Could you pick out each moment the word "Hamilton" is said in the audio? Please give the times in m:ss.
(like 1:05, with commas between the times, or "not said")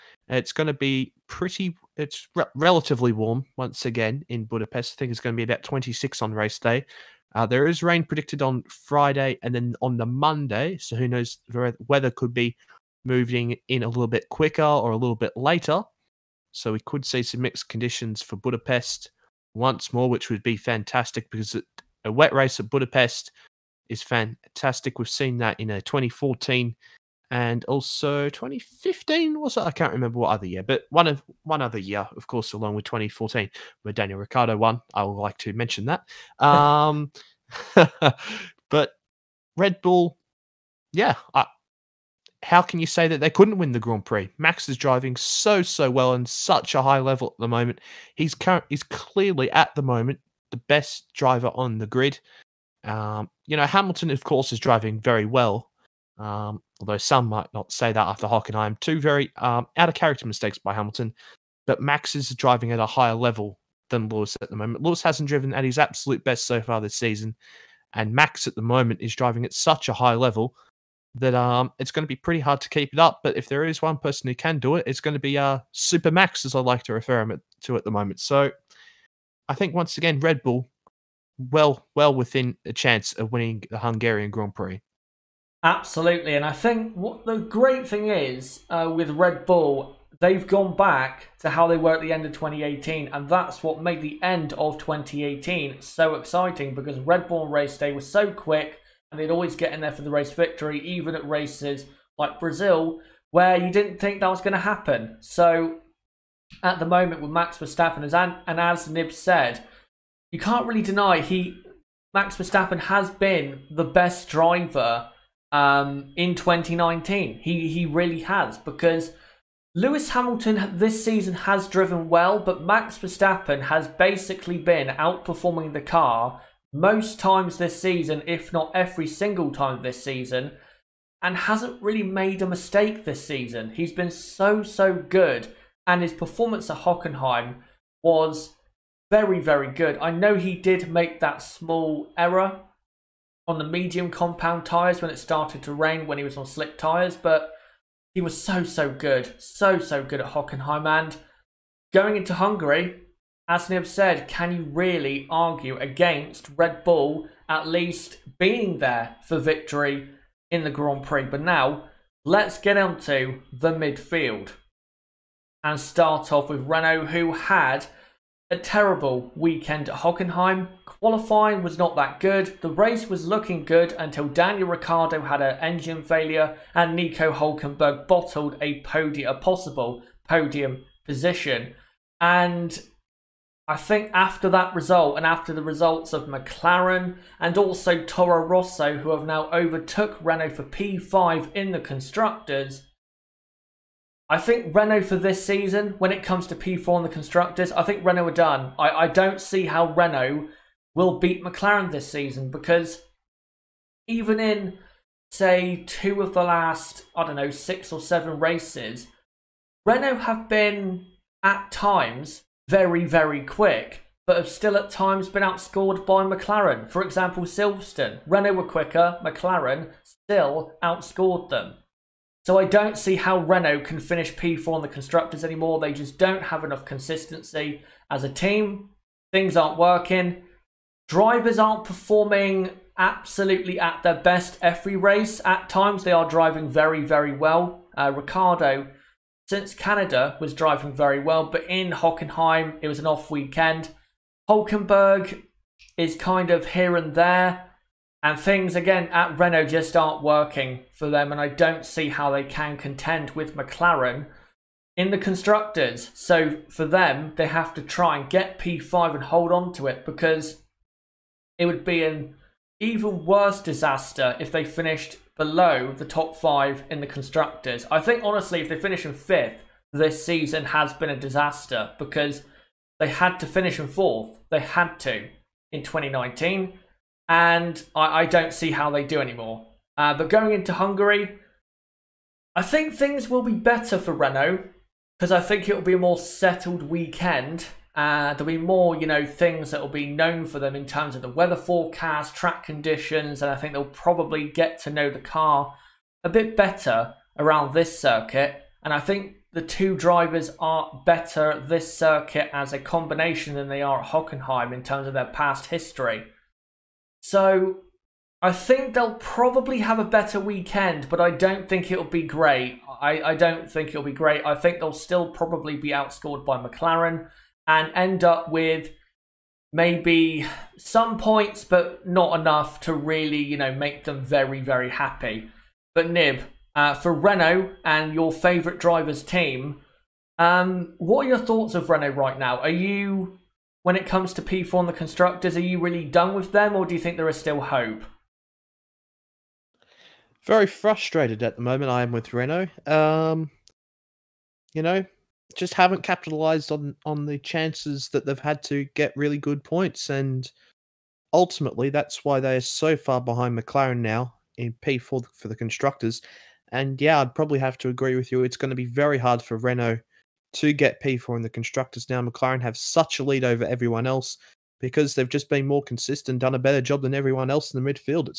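0:53, 1:00, 2:00.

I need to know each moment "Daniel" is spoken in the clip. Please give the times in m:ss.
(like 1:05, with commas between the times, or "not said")
0:33, 2:54.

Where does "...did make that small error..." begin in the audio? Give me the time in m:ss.
2:20.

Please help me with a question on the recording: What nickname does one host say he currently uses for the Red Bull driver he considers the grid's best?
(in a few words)
Super Max.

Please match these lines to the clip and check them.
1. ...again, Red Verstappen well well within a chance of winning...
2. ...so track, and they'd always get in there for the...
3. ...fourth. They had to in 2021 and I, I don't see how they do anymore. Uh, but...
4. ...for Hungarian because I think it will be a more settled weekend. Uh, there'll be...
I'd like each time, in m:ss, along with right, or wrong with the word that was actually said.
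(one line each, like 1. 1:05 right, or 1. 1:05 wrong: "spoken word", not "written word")
1. 1:19 wrong: "Bull", not "Verstappen"
2. 1:38 wrong: "quick", not "track"
3. 4:33 wrong: "2019", not "2021"
4. 4:43 wrong: "Renault", not "Hungarian".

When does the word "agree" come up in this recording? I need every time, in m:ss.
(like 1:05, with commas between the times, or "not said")
5:57.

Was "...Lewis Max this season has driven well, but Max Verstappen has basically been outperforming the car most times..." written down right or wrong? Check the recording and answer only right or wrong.
wrong.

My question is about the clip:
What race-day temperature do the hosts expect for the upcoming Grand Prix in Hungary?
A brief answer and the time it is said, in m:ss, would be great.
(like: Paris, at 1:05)
26, at 0:05.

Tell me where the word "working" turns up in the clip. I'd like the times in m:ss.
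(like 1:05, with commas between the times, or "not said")
3:49, 4:10.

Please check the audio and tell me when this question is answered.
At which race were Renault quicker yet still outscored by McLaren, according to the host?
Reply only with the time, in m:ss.
3:37.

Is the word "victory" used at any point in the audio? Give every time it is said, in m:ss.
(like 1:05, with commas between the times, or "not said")
1:40, 2:39.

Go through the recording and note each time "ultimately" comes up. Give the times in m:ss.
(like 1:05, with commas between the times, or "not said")
5:51.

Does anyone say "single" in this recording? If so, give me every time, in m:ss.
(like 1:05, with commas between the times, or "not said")
2:09.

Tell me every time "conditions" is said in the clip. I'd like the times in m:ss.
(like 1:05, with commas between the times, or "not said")
0:17, 4:52.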